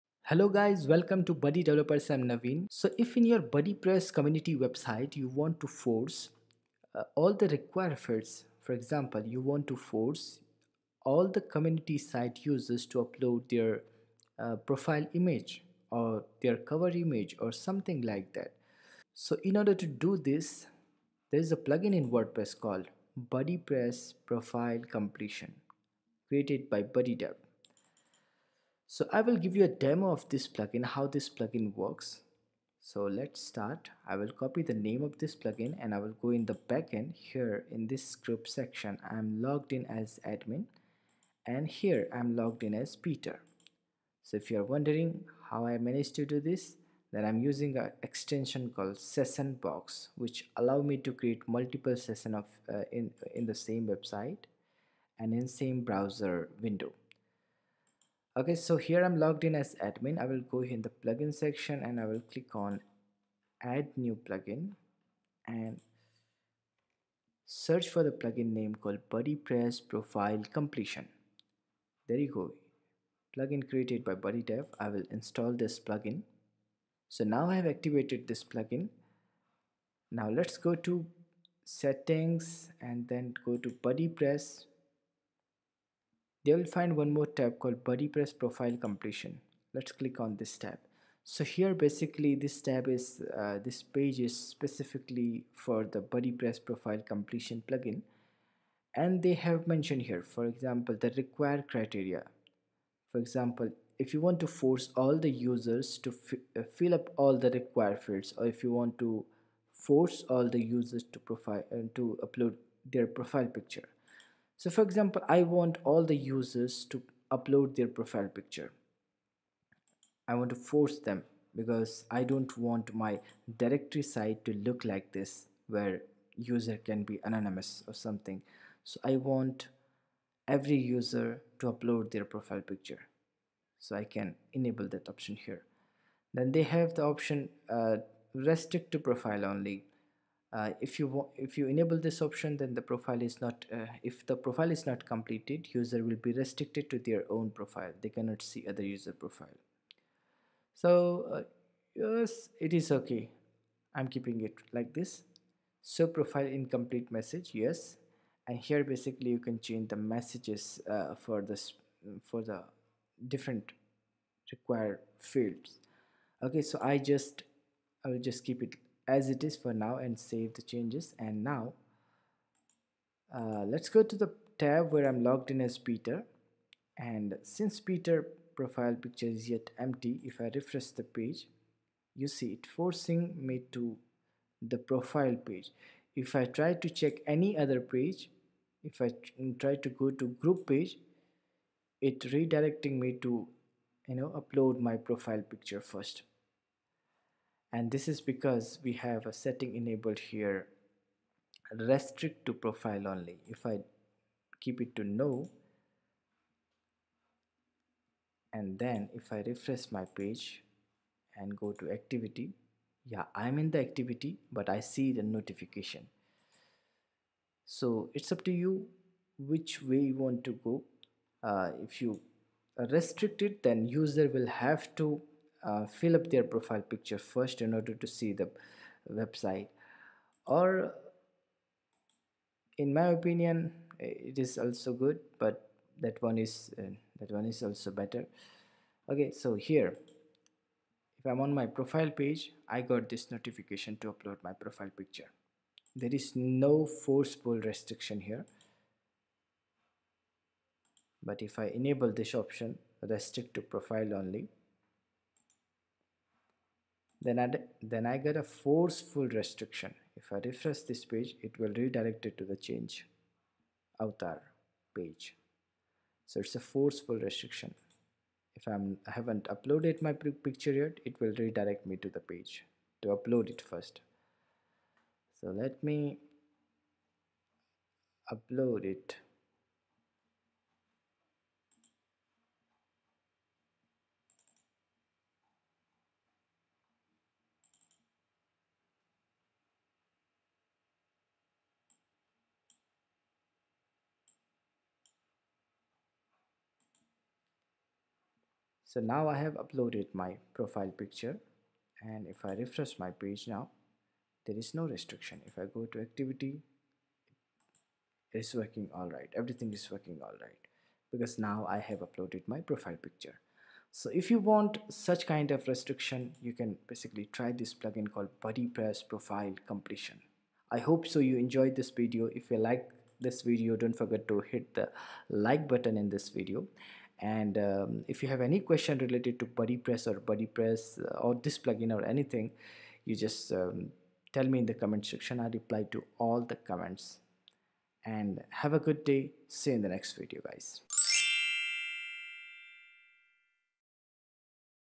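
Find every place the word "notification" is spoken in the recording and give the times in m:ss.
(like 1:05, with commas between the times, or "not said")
3:35, 4:03.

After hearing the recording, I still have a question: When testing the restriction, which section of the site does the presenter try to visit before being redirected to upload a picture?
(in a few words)
Group page.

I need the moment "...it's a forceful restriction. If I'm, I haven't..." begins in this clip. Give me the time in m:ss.
4:26.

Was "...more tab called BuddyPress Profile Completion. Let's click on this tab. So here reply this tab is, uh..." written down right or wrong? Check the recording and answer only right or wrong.
wrong.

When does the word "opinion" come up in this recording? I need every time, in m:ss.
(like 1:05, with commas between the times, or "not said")
3:53.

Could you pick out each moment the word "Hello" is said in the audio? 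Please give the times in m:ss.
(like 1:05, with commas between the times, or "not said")
0:00.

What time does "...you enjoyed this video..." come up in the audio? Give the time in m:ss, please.
5:21.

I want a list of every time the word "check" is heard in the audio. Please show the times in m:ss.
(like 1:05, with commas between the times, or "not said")
3:06.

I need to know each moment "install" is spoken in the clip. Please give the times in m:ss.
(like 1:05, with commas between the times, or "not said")
1:15.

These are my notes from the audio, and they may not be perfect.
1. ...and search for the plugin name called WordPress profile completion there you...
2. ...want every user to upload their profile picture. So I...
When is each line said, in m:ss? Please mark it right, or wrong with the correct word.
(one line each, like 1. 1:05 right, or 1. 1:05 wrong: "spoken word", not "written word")
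1. 1:05 wrong: "BuddyPress", not "WordPress"
2. 2:09 right.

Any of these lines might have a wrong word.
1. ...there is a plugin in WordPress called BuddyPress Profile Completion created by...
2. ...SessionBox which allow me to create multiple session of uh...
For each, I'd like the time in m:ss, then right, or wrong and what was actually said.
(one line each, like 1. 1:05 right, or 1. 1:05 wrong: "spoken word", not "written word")
1. 0:21 right
2. 0:48 right.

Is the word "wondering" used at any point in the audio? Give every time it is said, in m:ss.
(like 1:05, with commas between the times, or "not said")
0:44.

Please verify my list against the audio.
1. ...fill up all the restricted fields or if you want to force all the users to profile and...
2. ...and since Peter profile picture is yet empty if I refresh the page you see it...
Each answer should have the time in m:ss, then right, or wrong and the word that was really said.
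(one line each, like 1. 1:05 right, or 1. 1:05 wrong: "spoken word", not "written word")
1. 1:46 wrong: "required", not "restricted"
2. 2:56 right.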